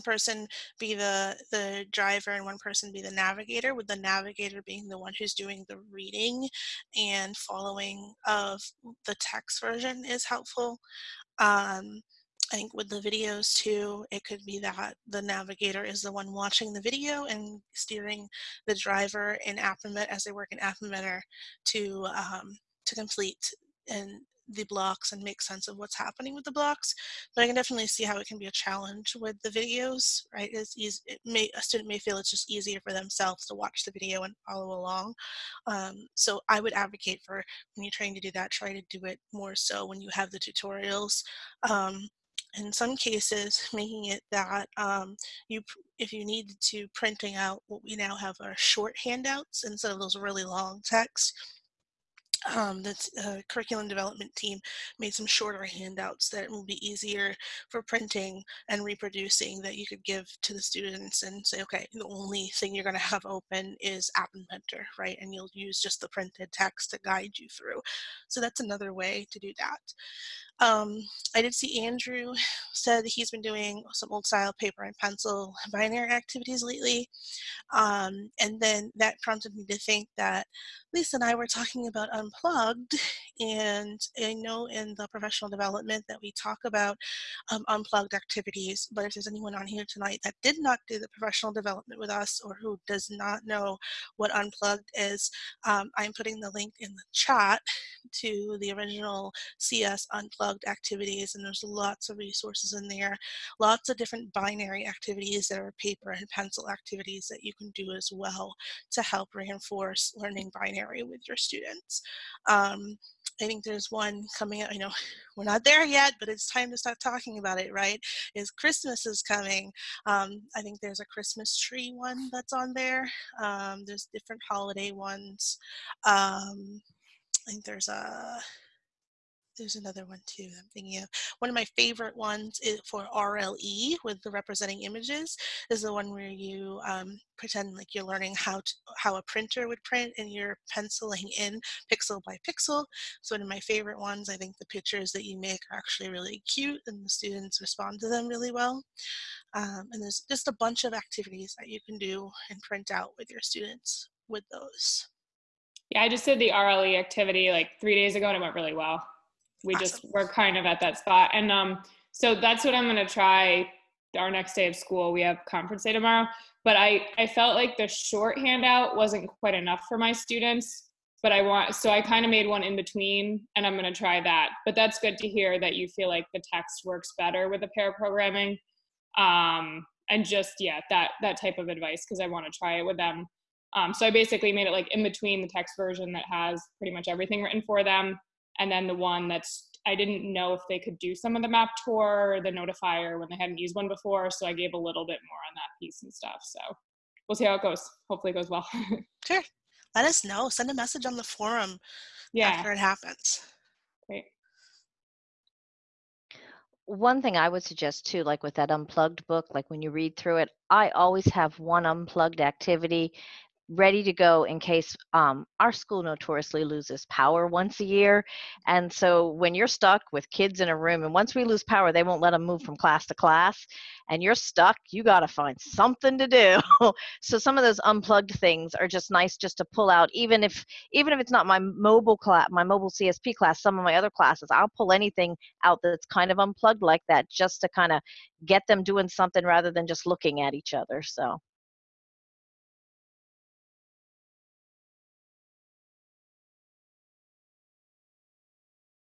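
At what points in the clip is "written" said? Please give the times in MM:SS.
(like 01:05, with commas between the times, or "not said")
03:07.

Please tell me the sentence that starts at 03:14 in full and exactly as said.
So I gave a little bit more on that piece and stuff.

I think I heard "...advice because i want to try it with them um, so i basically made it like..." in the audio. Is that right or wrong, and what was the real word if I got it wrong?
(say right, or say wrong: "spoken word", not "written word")
right.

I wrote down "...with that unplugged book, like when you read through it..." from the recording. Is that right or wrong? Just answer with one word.
right.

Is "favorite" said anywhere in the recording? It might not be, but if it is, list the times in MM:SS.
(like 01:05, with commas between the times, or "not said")
02:11, 02:23.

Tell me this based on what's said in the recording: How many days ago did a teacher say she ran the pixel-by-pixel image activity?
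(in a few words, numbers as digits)
3.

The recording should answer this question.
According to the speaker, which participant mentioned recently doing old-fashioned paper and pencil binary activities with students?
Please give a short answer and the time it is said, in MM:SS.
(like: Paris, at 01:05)
Andrew, at 01:11.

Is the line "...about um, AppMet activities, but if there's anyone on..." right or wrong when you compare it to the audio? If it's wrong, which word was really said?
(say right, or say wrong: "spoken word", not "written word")
wrong: "Unplugged", not "AppMet".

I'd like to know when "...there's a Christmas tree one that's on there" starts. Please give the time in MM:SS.
02:00.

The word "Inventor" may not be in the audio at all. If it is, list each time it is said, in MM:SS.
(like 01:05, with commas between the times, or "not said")
00:20, 01:04.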